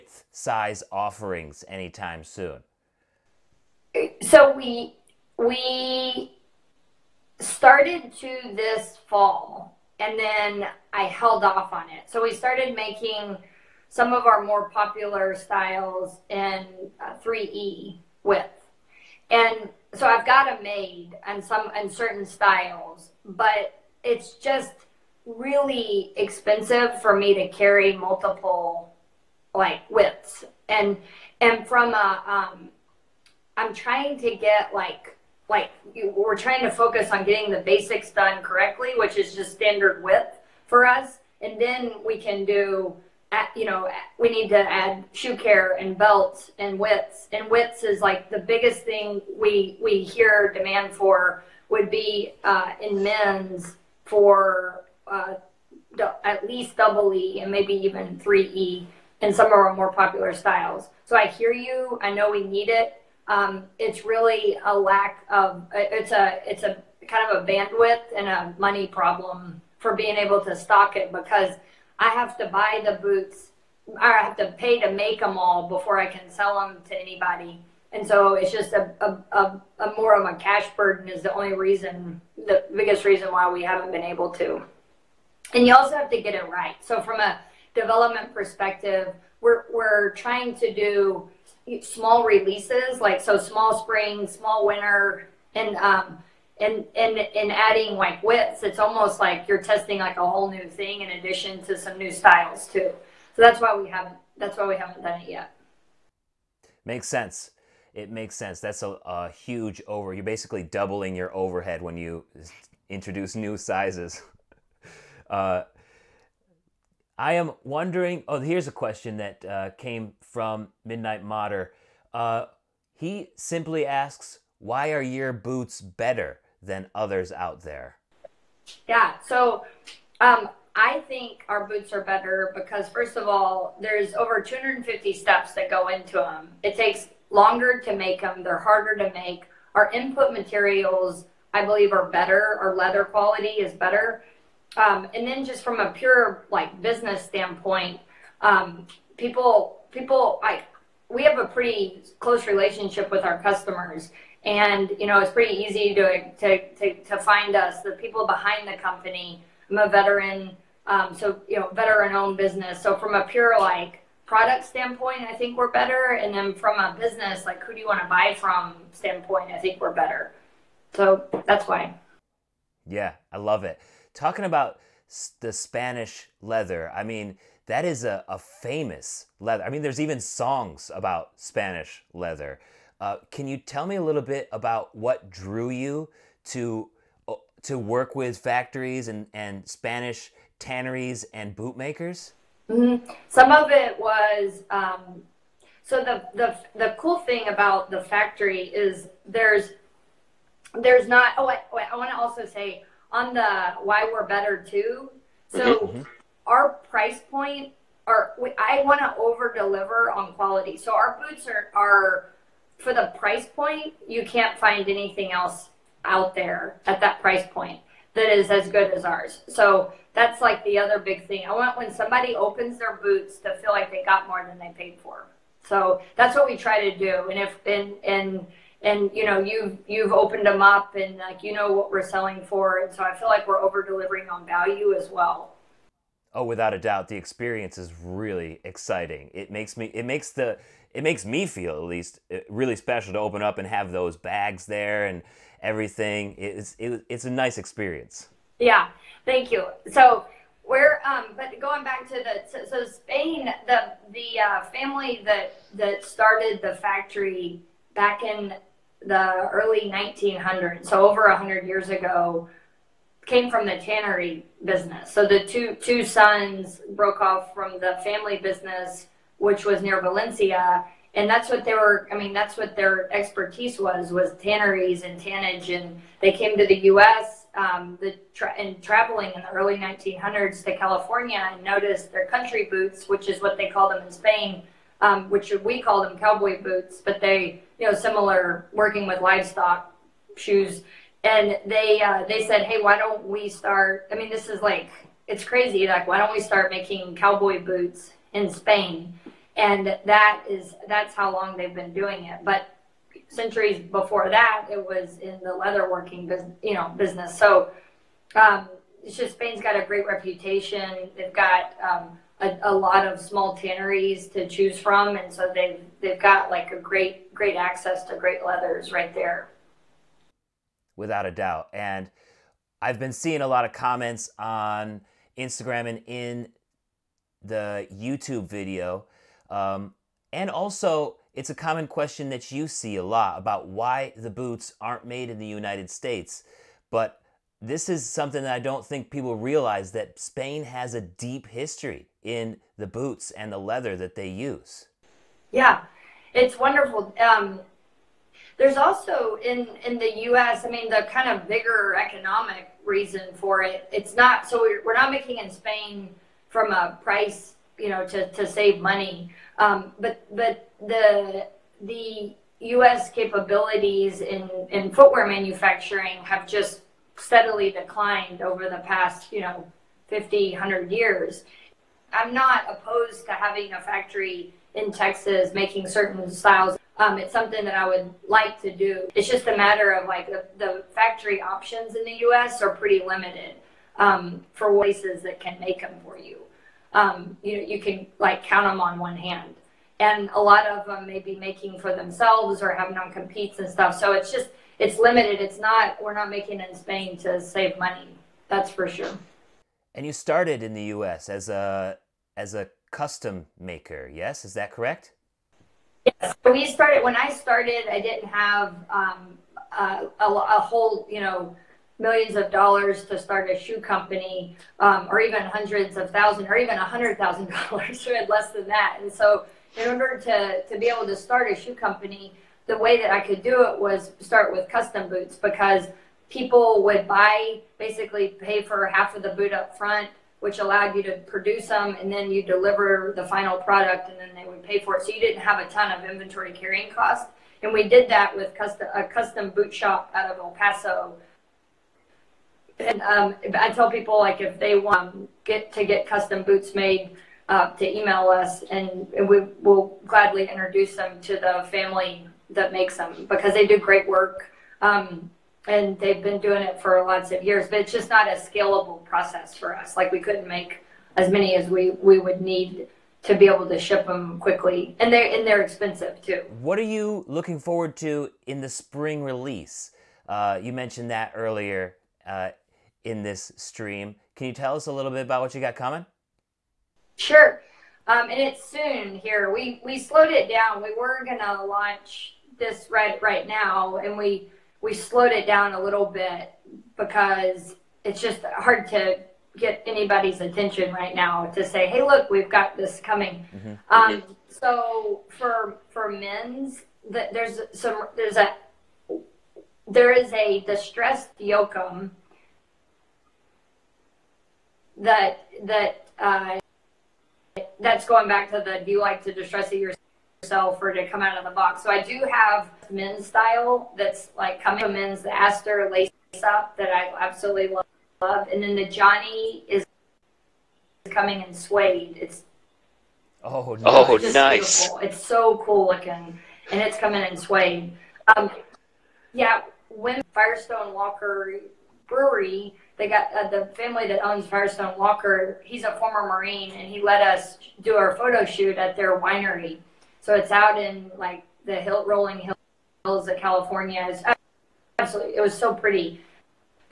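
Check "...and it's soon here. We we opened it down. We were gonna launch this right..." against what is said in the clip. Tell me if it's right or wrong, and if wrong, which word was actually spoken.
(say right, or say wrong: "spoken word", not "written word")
wrong: "slowed", not "opened".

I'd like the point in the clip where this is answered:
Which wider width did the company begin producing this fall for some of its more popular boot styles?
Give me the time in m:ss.
0:17.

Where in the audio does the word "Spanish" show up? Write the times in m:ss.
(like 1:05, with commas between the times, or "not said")
2:55, 3:01, 3:09.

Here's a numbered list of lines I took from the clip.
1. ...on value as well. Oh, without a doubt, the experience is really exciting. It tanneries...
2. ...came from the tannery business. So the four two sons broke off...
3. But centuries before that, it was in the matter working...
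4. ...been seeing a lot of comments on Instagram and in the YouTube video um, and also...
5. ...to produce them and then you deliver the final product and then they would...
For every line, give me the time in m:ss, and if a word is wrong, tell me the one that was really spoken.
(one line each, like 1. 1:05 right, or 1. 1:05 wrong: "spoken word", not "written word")
1. 3:54 wrong: "makes", not "tanneries"
2. 4:23 wrong: "two", not "four"
3. 5:02 wrong: "leather", not "matter"
4. 5:22 right
5. 7:11 right.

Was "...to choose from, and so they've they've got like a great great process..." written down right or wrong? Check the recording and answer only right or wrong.
wrong.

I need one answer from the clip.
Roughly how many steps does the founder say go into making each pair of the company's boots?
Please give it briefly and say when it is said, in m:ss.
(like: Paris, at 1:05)
over 250, at 2:14.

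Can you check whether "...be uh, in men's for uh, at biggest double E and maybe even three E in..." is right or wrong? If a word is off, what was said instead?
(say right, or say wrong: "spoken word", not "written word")
wrong: "least", not "biggest".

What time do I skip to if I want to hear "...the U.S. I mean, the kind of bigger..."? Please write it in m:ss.
5:49.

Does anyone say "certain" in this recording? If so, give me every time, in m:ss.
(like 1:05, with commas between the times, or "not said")
0:21, 6:15.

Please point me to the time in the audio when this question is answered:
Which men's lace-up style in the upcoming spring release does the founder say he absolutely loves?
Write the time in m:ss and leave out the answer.
8:35.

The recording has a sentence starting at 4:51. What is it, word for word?
And they, uh, they said, hey, why don't we start?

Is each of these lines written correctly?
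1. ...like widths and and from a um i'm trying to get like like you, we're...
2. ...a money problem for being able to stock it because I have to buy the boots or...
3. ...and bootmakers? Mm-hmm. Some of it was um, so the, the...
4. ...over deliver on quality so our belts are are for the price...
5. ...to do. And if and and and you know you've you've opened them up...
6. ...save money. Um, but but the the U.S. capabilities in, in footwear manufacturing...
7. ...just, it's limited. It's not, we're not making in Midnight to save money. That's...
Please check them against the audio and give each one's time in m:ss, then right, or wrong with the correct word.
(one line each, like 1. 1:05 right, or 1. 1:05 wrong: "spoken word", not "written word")
1. 0:29 right
2. 1:08 right
3. 3:11 right
4. 3:29 wrong: "boots", not "belts"
5. 3:46 right
6. 5:58 right
7. 6:34 wrong: "Spain", not "Midnight".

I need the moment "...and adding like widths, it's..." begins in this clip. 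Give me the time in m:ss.
1:37.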